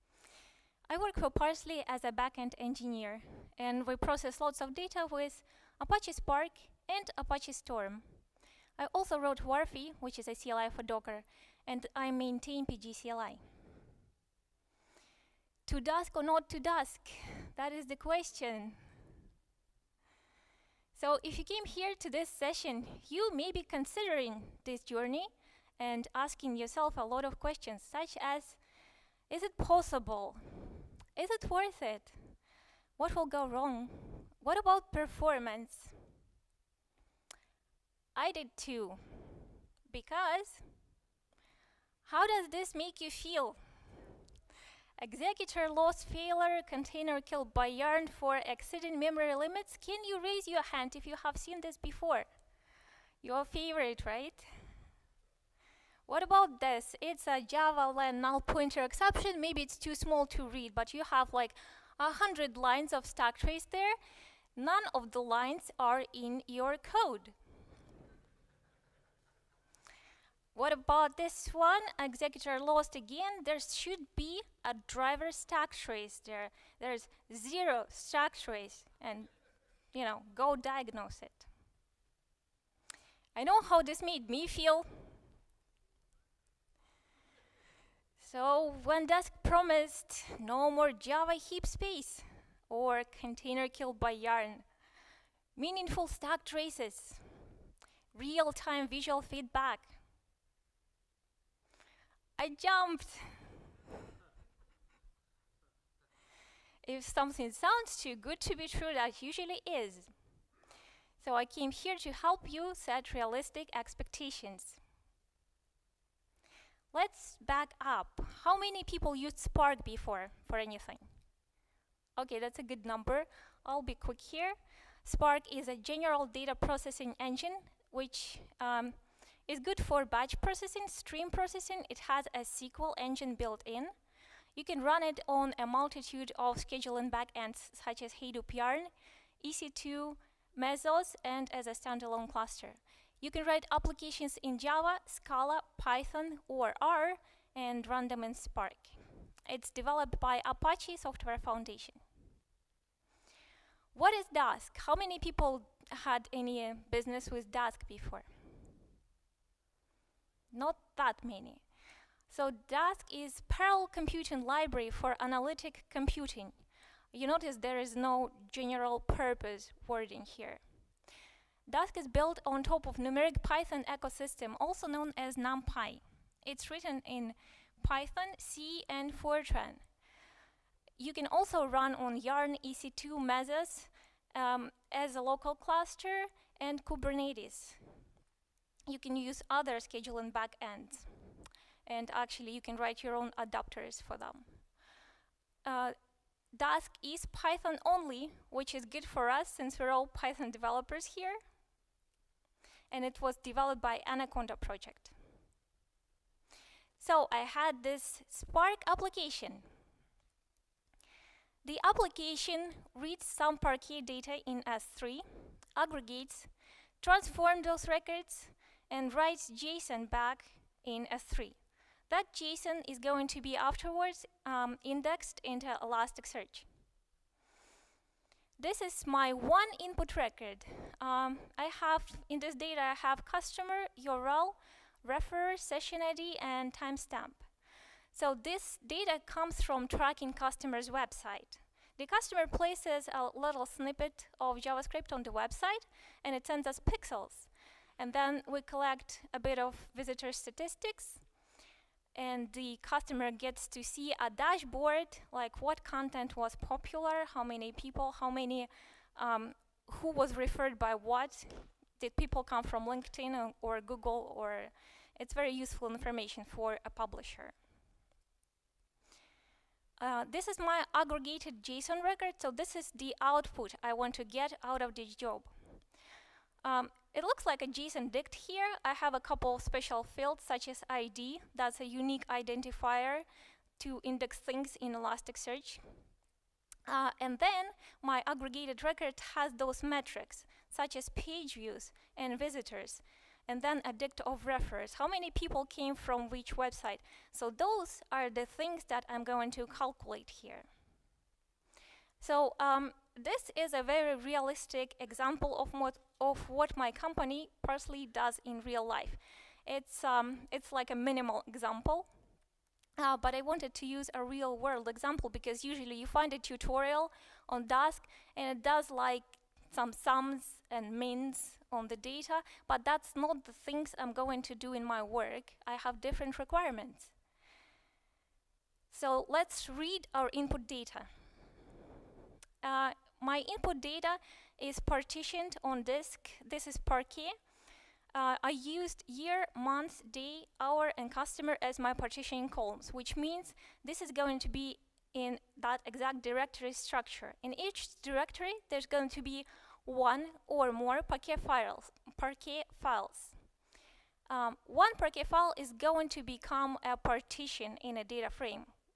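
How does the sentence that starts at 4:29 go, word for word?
Uh, this is my aggregated JSON record, so this is the output I want to get out of this job.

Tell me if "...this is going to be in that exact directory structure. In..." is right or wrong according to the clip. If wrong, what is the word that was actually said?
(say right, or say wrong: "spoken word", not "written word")
right.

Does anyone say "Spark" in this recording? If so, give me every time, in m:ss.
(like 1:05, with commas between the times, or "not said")
0:06, 1:59, 2:05, 2:28, 3:28.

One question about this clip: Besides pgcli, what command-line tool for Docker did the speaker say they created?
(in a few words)
wharfee.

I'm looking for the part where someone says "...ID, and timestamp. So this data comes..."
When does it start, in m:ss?
3:56.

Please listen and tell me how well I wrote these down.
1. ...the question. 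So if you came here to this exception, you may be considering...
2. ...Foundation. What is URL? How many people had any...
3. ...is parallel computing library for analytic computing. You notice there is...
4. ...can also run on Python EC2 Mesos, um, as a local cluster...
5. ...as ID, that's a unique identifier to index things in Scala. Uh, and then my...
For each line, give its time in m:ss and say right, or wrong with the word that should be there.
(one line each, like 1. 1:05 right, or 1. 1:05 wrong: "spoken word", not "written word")
1. 0:17 wrong: "session", not "exception"
2. 2:31 wrong: "Dask", not "URL"
3. 2:43 right
4. 3:01 wrong: "Yarn", not "Python"
5. 4:40 wrong: "Elasticsearch", not "Scala".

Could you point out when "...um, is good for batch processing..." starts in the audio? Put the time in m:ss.
2:08.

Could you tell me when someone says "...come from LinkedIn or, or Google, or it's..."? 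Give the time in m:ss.
4:22.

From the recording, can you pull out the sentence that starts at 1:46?
if something sounds too good to be true, that usually is.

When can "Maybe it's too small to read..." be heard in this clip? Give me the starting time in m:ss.
0:59.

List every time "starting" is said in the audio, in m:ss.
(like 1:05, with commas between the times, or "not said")
not said.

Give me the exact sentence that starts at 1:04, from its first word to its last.
None of the lines are in your code.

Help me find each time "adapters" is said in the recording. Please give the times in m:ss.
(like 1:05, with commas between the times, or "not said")
3:13.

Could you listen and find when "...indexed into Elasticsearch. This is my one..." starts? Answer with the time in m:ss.
3:44.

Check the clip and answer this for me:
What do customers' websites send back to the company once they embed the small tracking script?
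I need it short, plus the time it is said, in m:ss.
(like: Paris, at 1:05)
pixels, at 4:06.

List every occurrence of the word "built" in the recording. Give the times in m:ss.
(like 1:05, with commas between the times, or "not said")
2:13, 2:52.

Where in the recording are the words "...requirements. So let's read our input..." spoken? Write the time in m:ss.
5:26.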